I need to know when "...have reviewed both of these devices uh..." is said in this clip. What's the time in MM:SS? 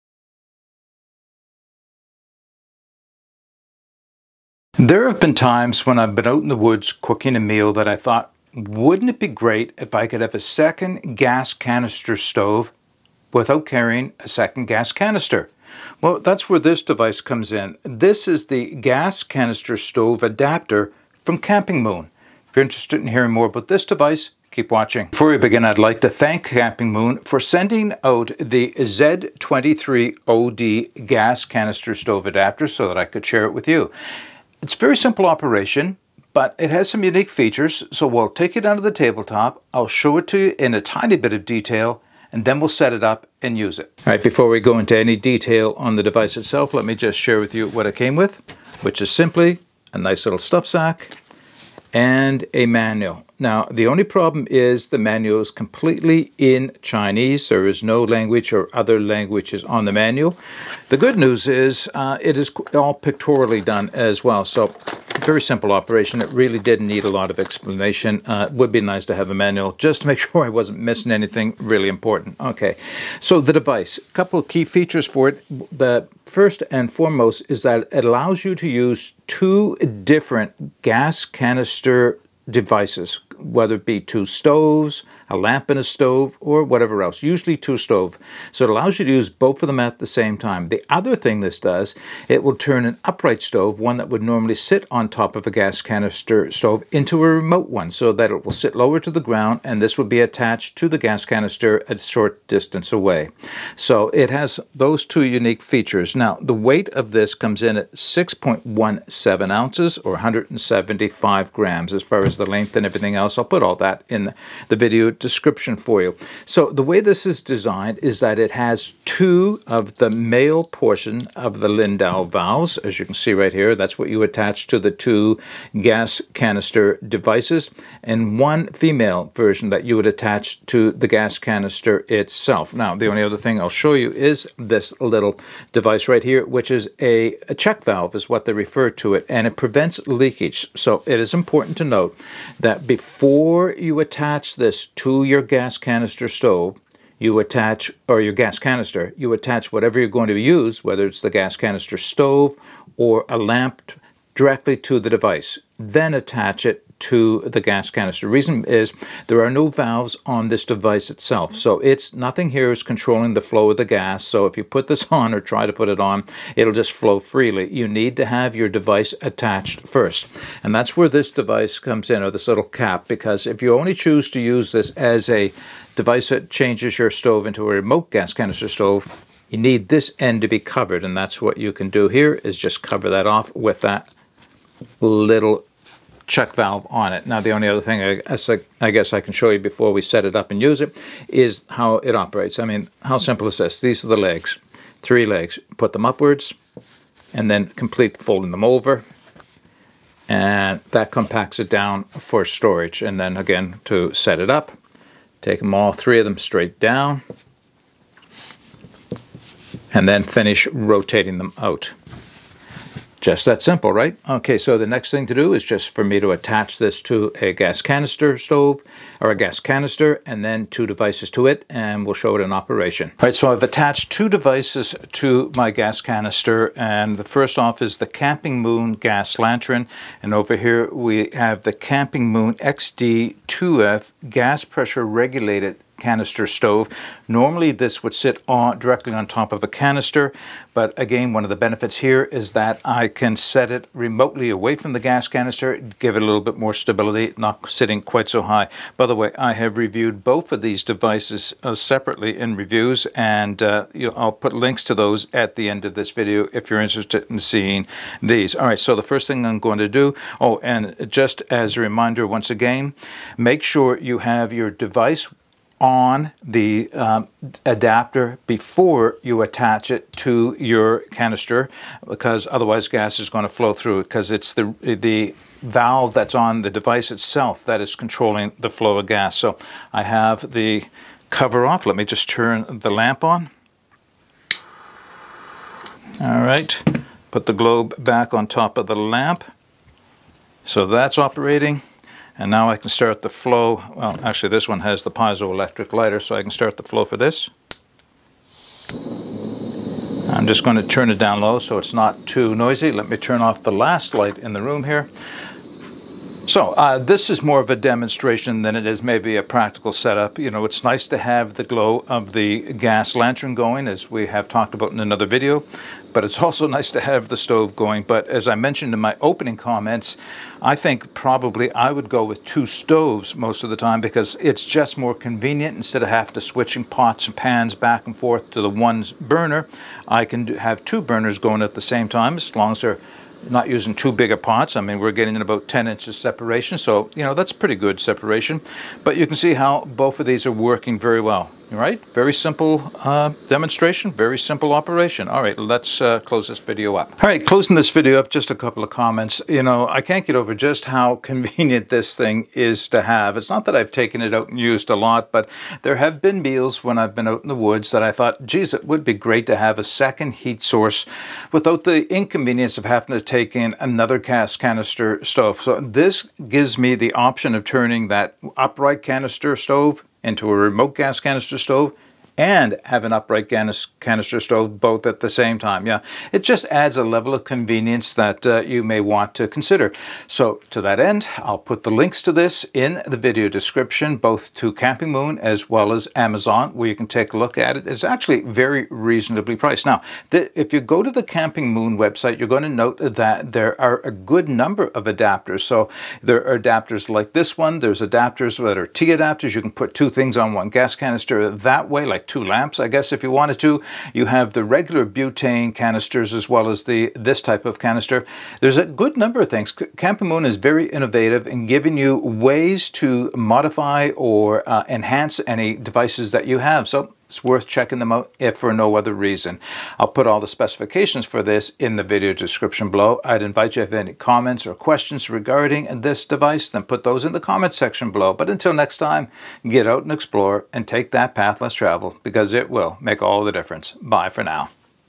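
04:09.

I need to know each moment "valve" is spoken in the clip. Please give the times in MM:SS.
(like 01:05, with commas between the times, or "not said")
02:02, 02:17, 02:39, 03:06, 04:35.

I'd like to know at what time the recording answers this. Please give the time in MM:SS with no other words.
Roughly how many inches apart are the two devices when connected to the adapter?
05:35.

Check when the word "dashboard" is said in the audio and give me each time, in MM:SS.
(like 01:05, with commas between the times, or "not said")
not said.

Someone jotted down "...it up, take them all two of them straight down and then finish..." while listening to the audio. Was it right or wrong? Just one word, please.
wrong.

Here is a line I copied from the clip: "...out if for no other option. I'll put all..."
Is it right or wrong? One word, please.
wrong.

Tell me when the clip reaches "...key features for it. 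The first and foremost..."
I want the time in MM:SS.
01:14.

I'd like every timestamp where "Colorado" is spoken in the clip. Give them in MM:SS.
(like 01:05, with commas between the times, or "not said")
not said.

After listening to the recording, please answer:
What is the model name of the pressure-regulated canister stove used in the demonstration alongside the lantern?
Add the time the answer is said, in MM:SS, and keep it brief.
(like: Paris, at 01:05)
XD2F, at 03:52.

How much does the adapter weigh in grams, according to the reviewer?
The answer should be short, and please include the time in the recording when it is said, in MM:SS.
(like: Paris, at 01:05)
175 grams, at 01:50.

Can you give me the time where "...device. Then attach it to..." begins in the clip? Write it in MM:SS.
02:35.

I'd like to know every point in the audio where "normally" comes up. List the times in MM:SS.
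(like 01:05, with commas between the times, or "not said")
01:34, 03:57.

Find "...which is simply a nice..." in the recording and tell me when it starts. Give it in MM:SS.
00:48.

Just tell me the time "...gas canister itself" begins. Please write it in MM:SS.
02:11.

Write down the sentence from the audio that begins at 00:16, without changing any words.
Well, that's where this device comes in.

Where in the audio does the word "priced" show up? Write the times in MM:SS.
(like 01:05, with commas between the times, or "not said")
06:29.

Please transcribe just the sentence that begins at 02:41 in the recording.
So it's nothing here is controlling the flow of the gas.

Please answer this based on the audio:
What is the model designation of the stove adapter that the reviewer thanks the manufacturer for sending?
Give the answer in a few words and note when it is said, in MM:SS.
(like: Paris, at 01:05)
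Z23OD, at 00:28.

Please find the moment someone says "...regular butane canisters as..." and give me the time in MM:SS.
06:44.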